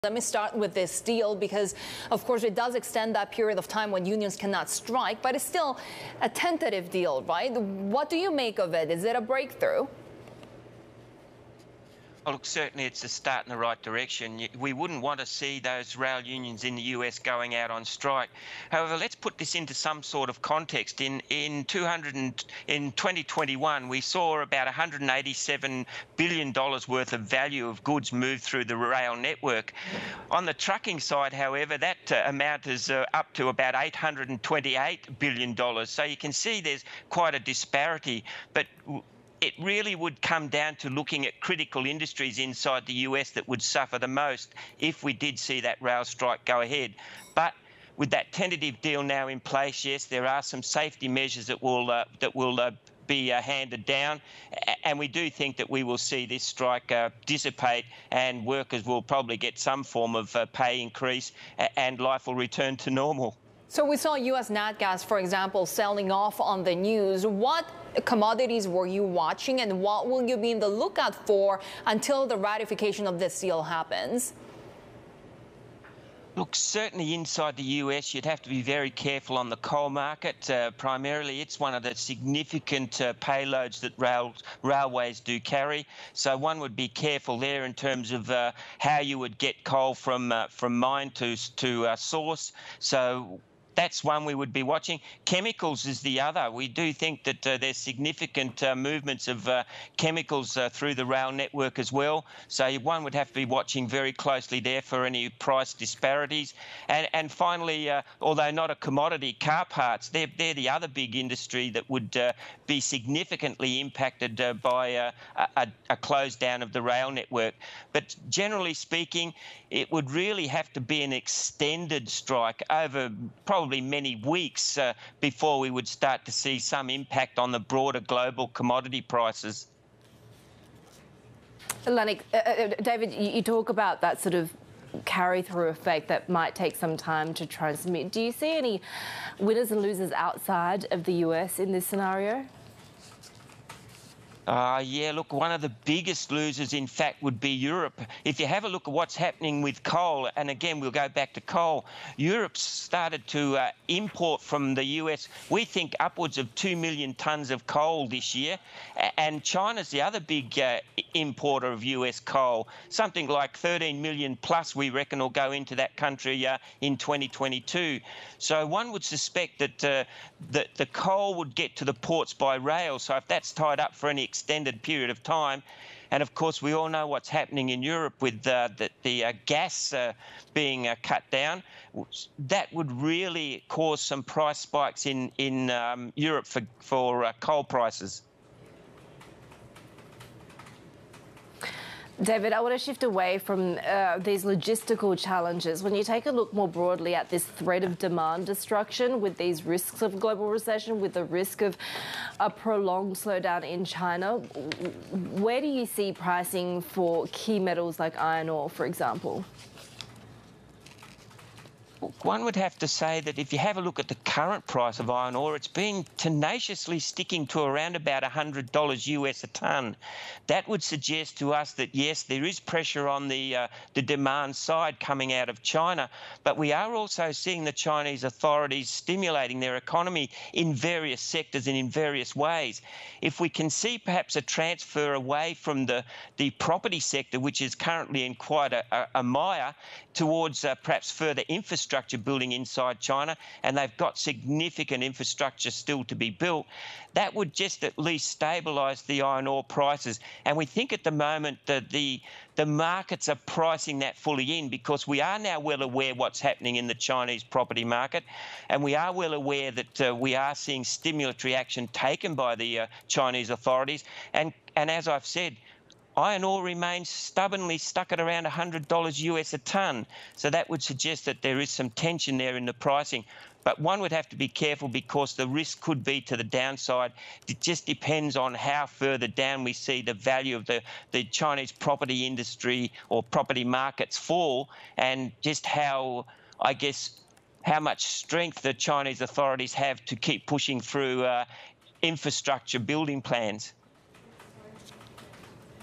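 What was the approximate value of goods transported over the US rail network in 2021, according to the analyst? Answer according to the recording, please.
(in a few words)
$187 billion.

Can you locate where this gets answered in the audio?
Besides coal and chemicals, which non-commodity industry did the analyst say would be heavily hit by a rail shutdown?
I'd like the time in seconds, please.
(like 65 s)
109 s.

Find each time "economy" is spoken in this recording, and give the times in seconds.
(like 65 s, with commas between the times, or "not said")
229 s.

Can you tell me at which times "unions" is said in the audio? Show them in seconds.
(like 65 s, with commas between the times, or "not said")
4 s, 16 s.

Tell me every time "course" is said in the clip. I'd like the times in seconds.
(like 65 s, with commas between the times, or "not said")
2 s, 176 s.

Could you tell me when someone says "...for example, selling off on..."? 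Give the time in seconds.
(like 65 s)
65 s.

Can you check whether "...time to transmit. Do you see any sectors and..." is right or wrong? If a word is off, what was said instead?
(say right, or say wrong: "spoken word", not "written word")
wrong: "winners", not "sectors".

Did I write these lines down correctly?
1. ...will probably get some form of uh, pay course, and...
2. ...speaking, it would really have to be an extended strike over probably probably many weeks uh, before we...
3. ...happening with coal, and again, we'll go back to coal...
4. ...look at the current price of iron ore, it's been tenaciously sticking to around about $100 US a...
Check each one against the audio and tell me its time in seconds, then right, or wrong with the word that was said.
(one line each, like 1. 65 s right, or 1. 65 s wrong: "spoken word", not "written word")
1. 58 s wrong: "increase", not "course"
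2. 118 s right
3. 149 s right
4. 213 s right.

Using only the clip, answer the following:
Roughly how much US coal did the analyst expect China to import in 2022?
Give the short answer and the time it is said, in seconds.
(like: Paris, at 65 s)
13 million tonnes, at 163 s.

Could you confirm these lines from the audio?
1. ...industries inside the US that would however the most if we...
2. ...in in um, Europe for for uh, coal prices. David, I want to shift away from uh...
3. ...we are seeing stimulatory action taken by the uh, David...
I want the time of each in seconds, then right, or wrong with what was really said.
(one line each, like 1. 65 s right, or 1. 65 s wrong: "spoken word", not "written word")
1. 41 s wrong: "suffer", not "however"
2. 185 s right
3. 260 s wrong: "Chinese", not "David".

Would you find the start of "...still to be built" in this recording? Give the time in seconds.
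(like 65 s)
245 s.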